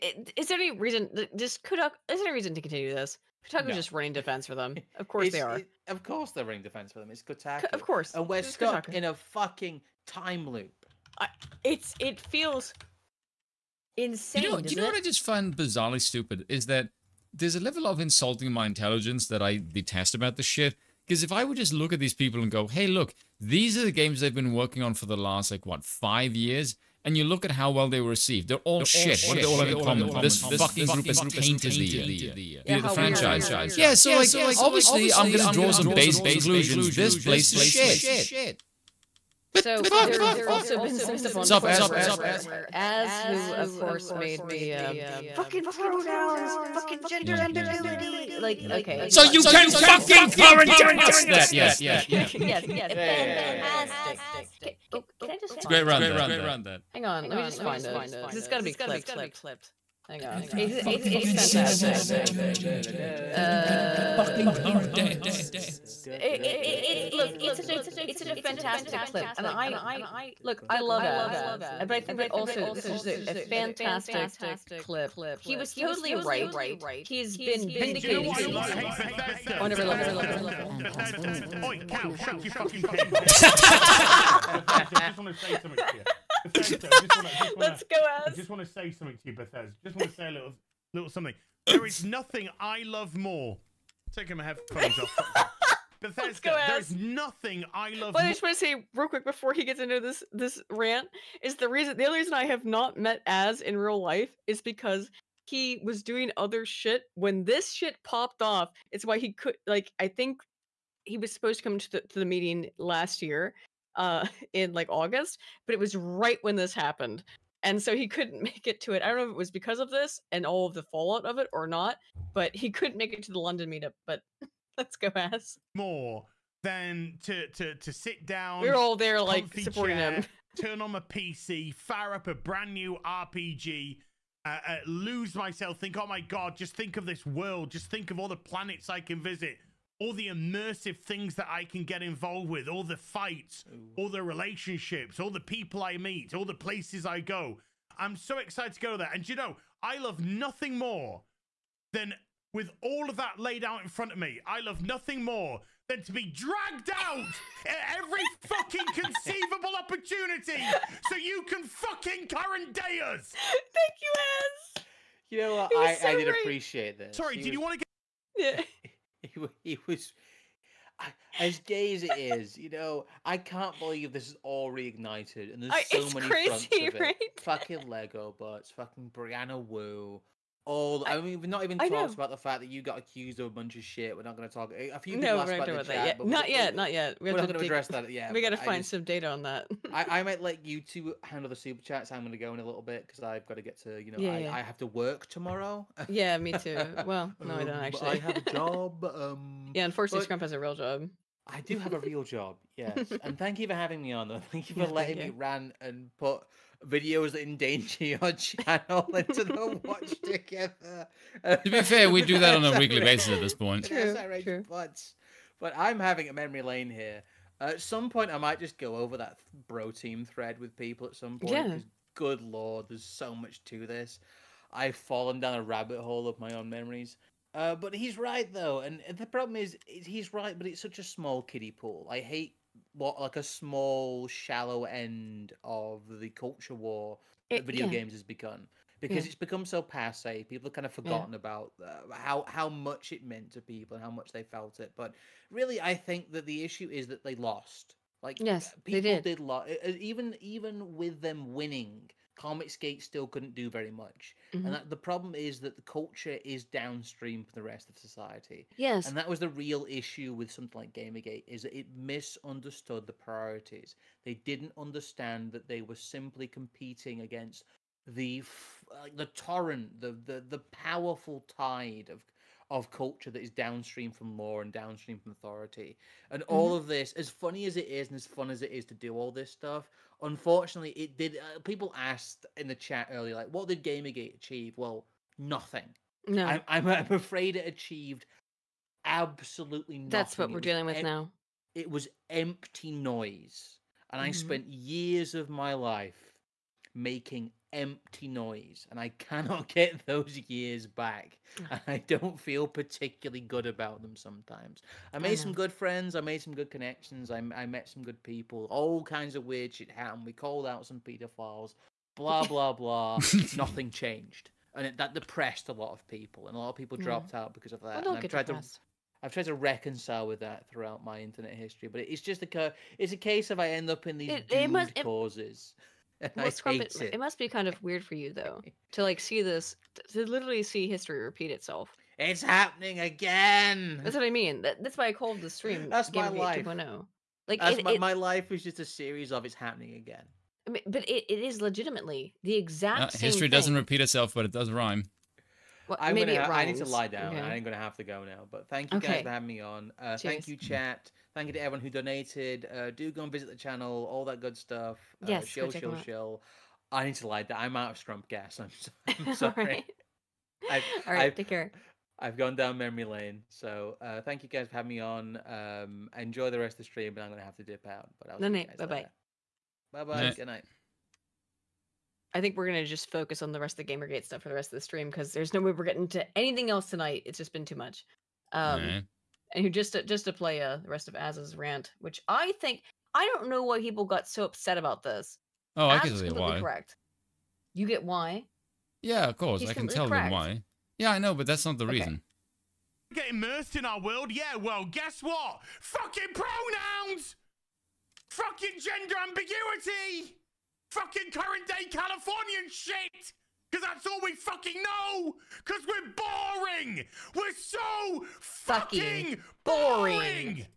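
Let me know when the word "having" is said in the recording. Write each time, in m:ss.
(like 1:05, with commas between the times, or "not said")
3:23, 3:35, 5:49, 6:04.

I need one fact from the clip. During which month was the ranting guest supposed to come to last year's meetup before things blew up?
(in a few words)
August.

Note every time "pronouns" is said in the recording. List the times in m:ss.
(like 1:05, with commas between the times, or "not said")
0:45, 6:36.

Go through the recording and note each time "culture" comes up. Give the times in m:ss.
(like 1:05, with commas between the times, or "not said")
3:56, 4:15, 4:32.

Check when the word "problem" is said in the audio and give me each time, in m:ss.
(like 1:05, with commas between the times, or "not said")
3:49, 4:14.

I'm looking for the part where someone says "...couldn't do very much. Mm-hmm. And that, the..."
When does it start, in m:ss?
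4:13.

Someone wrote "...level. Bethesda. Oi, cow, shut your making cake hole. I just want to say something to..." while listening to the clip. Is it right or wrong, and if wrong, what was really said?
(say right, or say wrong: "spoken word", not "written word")
wrong: "fucking", not "making".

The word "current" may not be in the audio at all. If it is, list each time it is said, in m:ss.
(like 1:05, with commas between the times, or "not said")
1:04, 2:42, 6:41.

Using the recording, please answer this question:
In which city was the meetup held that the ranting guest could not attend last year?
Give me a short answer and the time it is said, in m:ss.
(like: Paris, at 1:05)
London, at 2:03.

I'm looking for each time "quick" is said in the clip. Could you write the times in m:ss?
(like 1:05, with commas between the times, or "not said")
1:39.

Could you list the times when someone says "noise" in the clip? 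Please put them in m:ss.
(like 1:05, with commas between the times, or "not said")
4:52, 4:58.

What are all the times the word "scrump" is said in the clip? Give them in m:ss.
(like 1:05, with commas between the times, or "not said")
3:20, 5:58.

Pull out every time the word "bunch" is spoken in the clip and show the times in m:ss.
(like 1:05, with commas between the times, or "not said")
3:03.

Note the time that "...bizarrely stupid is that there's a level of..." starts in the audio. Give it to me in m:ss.
0:15.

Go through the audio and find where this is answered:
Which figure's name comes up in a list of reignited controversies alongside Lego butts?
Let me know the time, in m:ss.
2:59.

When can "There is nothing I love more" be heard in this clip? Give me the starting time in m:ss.
1:31.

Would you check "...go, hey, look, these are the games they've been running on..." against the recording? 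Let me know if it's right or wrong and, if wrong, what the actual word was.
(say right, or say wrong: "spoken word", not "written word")
wrong: "working", not "running".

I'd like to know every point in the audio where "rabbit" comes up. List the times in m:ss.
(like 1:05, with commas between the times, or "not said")
3:45.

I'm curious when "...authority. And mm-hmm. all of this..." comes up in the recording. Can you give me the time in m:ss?
4:35.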